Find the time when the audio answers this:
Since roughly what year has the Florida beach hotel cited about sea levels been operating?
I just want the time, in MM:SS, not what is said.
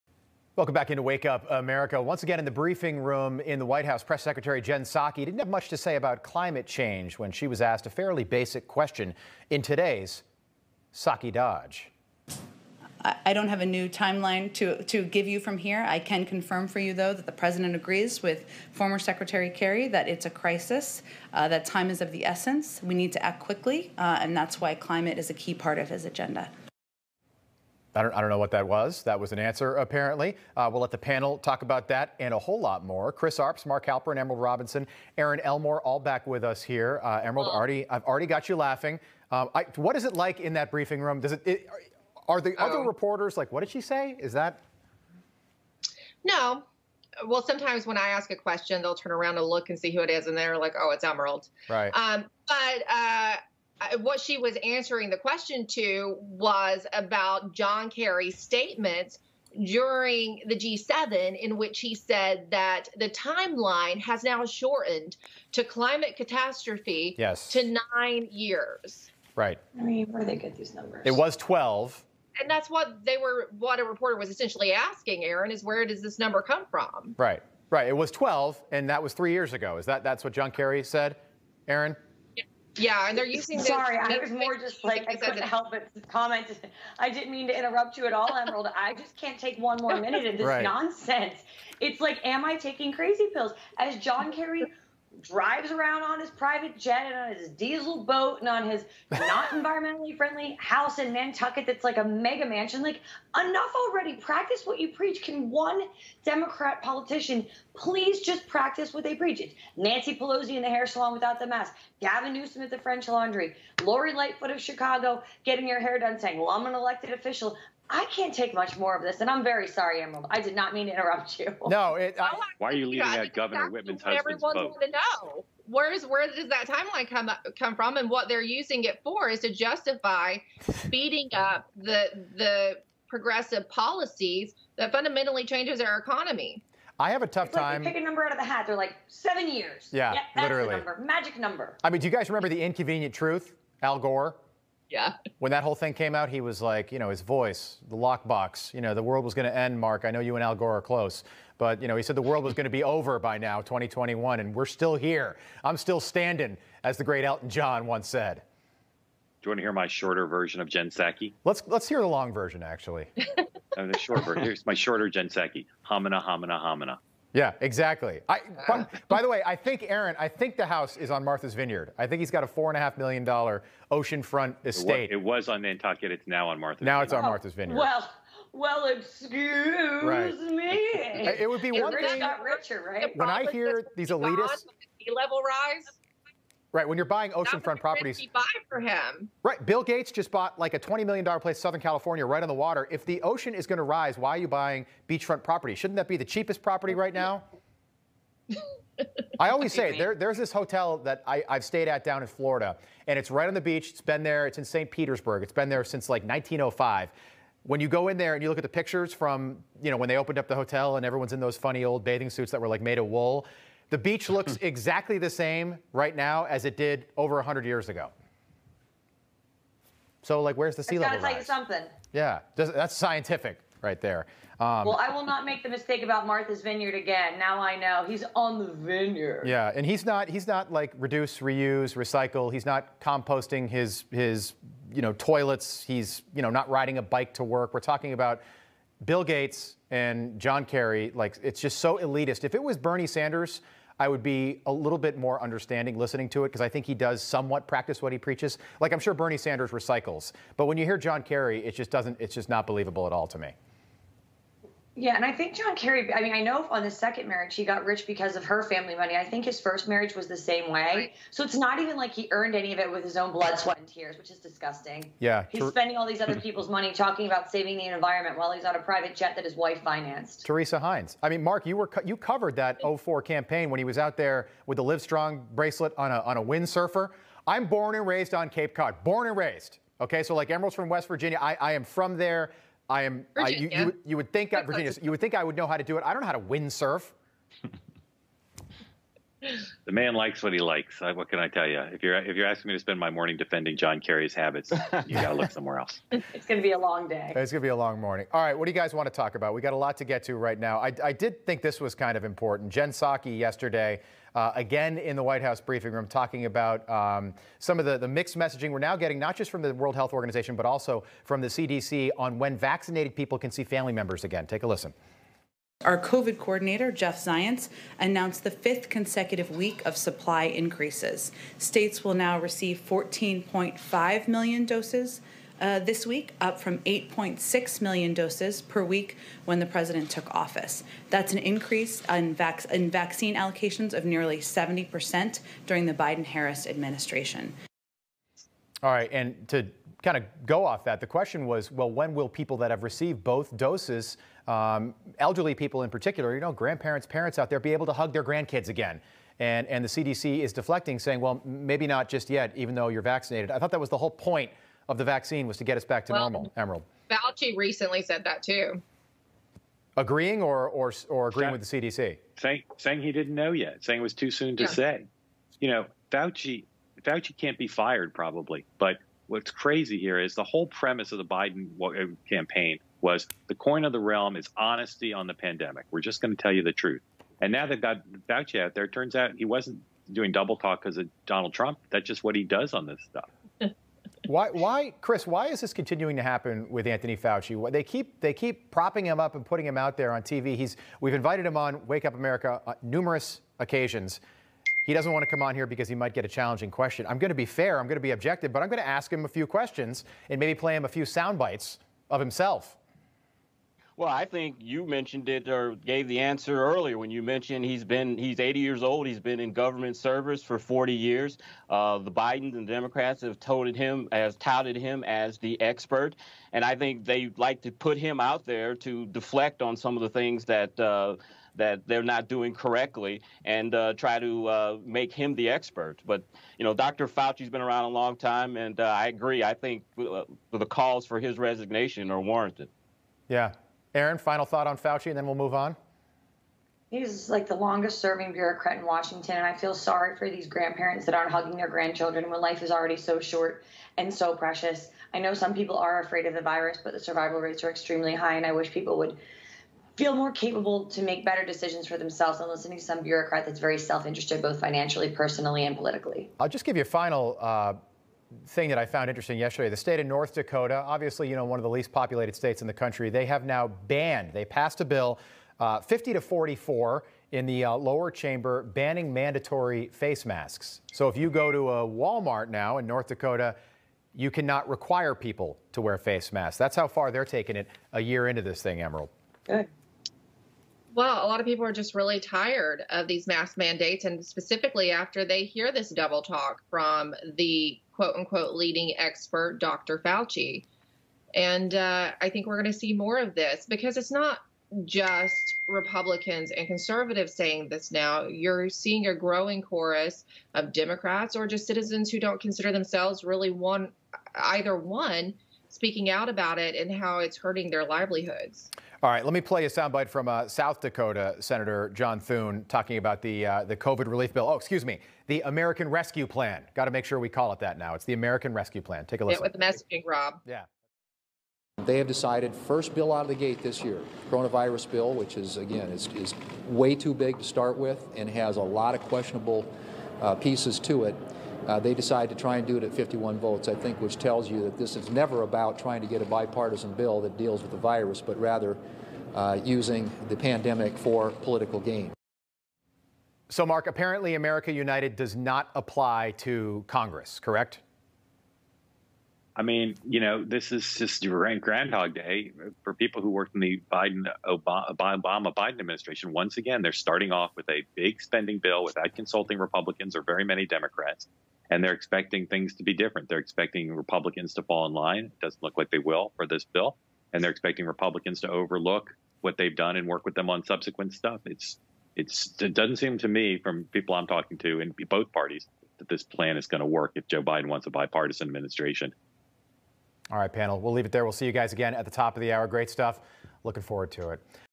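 03:26.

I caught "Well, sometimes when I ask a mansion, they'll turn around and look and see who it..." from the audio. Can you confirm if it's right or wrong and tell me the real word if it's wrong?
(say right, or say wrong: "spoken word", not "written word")
wrong: "question", not "mansion".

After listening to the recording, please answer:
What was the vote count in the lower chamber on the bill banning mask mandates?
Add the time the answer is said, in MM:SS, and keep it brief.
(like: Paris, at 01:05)
50 to 44, at 07:45.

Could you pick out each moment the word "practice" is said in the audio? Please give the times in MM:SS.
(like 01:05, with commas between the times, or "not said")
01:44, 01:48, 04:07.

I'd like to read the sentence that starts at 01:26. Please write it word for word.
I didn't mean to interrupt you at all, Emerald.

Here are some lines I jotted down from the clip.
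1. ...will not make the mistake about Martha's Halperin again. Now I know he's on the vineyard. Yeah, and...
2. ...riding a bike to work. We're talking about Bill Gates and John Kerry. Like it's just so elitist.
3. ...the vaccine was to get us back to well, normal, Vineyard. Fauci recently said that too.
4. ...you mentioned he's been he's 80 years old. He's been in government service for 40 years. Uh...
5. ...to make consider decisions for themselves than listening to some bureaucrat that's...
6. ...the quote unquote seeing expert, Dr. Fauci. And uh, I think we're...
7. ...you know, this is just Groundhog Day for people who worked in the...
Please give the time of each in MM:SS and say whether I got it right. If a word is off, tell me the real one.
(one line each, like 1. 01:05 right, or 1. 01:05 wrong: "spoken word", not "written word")
1. 03:45 wrong: "Vineyard", not "Halperin"
2. 03:56 right
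3. 05:54 wrong: "Emerald", not "Vineyard"
4. 06:47 right
5. 07:30 wrong: "better", not "consider"
6. 08:07 wrong: "leading", not "seeing"
7. 09:10 right.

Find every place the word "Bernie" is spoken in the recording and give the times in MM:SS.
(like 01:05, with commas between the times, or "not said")
04:02, 04:09.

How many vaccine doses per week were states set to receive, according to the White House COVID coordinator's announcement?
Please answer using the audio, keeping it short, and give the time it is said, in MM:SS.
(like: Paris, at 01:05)
14.5 million, at 05:22.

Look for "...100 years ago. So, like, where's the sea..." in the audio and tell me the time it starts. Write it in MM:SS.
03:37.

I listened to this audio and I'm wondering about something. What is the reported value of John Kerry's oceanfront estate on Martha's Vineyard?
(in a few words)
$4.5 million.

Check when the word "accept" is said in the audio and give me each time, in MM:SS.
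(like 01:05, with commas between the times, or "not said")
not said.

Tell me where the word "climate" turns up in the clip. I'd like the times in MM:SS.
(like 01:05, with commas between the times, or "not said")
00:06, 00:24, 01:05.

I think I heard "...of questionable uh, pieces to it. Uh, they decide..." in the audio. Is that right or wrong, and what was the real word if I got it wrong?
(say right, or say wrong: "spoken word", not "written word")
right.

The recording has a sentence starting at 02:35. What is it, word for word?
I'm still standing, as the great Elton John once said.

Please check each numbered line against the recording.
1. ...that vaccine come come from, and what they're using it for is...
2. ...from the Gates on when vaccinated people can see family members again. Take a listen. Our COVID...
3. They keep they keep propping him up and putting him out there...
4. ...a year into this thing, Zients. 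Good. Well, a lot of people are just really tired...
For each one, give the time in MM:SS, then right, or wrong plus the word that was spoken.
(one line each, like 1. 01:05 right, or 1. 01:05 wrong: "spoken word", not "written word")
1. 02:06 wrong: "timeline", not "vaccine"
2. 05:11 wrong: "CDC", not "Gates"
3. 06:27 right
4. 07:57 wrong: "Emerald", not "Zients".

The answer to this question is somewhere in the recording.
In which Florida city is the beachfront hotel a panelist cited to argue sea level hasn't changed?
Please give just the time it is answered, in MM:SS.
03:24.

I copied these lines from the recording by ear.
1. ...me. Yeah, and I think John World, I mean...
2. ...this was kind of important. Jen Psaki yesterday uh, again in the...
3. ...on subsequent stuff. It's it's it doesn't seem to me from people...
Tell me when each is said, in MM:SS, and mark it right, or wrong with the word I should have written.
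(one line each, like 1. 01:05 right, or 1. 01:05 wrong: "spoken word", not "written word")
1. 04:13 wrong: "Kerry", not "World"
2. 05:01 right
3. 09:30 right.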